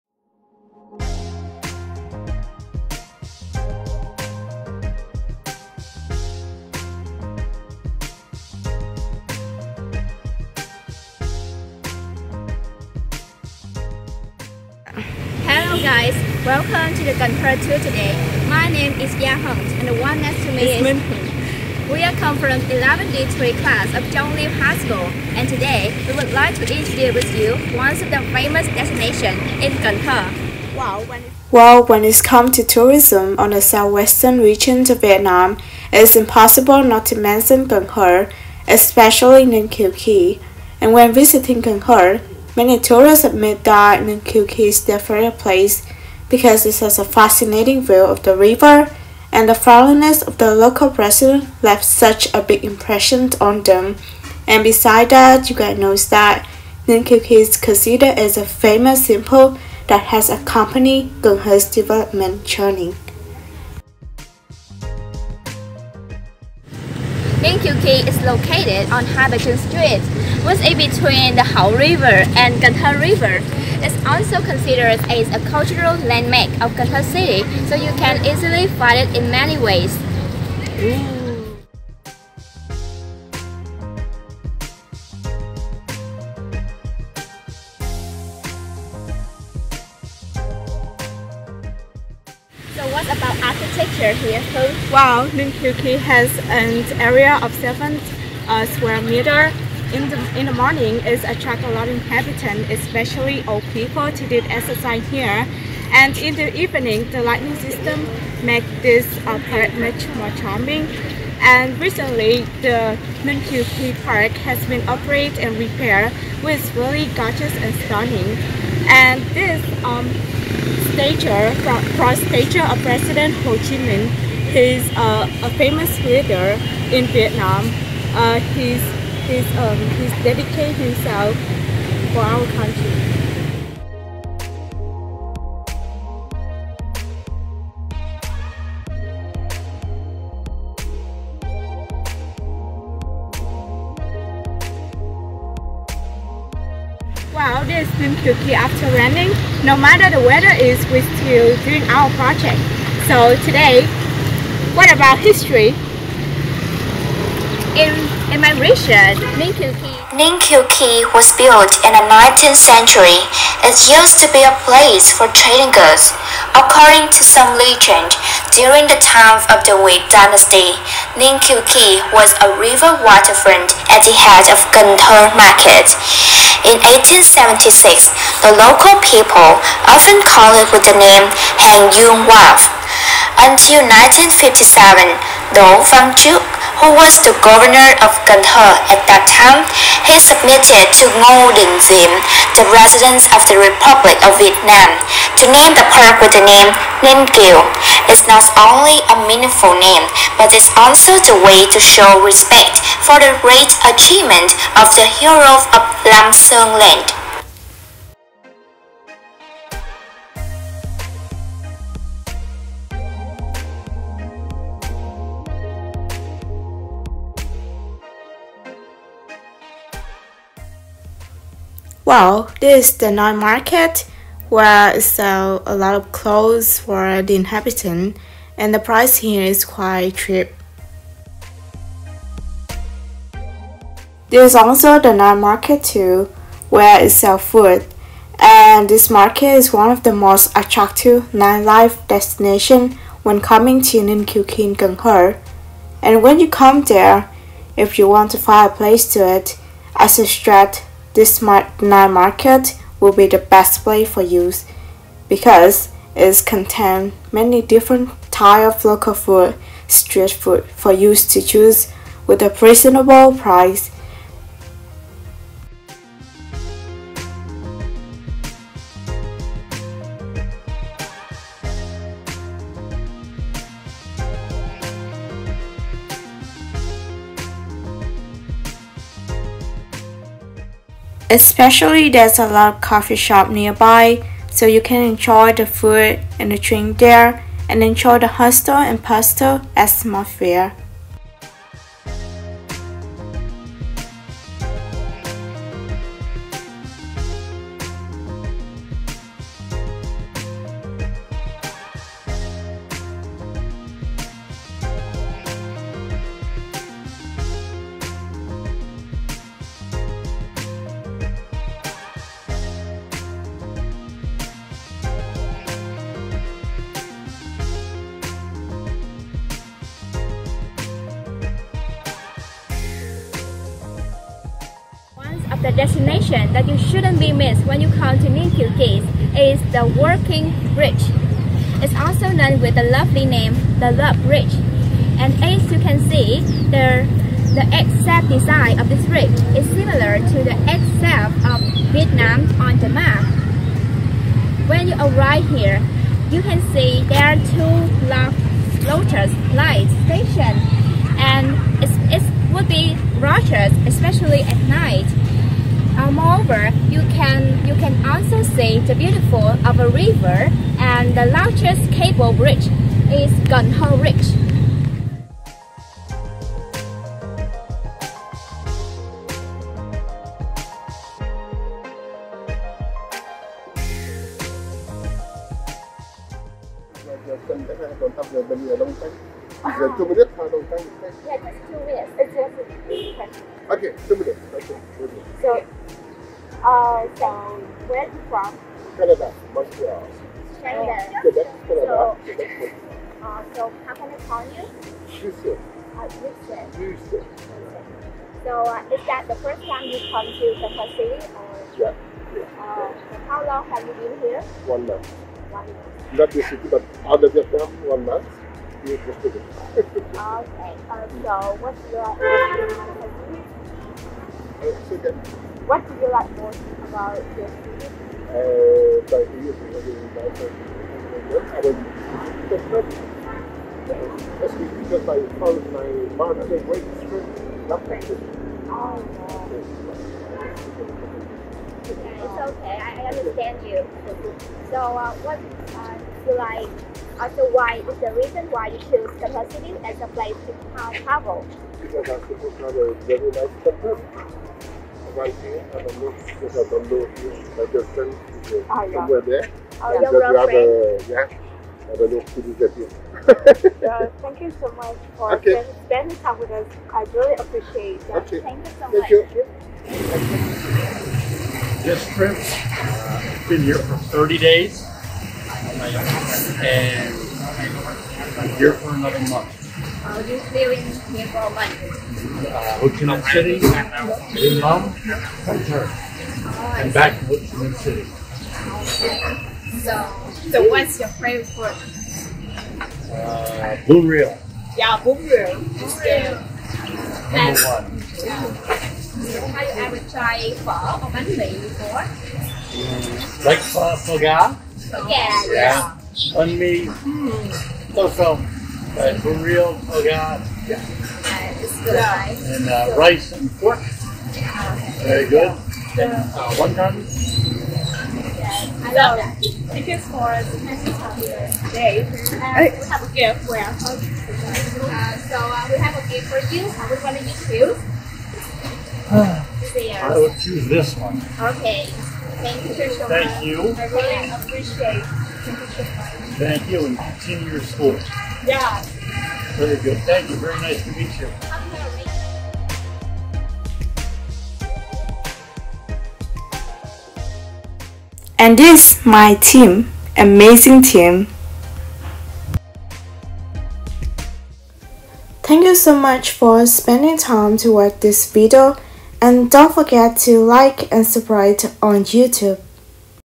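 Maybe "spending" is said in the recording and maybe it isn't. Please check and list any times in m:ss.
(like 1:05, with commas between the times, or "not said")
7:35, 9:06.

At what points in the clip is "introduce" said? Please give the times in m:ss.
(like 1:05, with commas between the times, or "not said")
0:26.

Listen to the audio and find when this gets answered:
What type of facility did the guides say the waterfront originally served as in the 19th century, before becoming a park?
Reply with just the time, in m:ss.
2:44.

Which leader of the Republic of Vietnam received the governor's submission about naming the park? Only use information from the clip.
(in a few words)
Ngo Dinh Diem.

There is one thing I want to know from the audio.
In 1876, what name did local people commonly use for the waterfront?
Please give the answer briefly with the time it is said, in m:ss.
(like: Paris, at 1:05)
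Hang Duong Wharf, at 3:01.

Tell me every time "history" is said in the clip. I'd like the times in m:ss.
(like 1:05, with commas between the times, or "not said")
2:35.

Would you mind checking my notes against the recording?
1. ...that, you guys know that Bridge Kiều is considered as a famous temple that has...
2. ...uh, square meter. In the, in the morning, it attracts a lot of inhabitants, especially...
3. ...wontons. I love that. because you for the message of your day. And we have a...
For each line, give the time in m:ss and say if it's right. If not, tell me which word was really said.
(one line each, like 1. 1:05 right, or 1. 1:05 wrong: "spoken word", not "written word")
1. 0:55 wrong: "Ninh", not "Bridge"
2. 1:38 right
3. 8:26 right.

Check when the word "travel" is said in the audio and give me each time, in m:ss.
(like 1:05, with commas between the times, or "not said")
7:21.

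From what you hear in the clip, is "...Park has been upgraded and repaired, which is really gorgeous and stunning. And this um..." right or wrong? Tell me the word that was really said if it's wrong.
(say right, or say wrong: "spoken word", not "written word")
right.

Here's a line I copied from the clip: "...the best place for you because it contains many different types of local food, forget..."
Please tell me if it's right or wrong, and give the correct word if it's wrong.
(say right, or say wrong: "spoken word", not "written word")
wrong: "street", not "forget".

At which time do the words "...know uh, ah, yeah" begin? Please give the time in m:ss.
7:26.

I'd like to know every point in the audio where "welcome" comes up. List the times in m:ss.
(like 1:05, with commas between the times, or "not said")
0:16.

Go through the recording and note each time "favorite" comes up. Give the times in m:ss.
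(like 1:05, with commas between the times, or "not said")
0:44, 8:01.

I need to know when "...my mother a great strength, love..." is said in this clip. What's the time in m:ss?
7:05.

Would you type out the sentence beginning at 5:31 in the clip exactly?
It's also known with the lovely name, the Love Bridge.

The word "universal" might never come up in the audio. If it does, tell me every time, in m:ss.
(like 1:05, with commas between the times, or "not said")
not said.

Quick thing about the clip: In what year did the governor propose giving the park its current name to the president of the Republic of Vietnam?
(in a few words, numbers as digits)
1957.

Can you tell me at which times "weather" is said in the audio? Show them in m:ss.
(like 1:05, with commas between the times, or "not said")
2:30.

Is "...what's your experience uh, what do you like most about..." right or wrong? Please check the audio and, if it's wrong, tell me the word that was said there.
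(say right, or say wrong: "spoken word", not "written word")
right.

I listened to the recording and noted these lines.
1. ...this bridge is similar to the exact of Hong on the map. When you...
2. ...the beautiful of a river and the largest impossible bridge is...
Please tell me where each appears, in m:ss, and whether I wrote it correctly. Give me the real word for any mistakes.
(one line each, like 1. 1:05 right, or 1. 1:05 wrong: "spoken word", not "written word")
1. 5:38 wrong: "Vietnam", not "Hong"
2. 5:58 wrong: "cable", not "impossible".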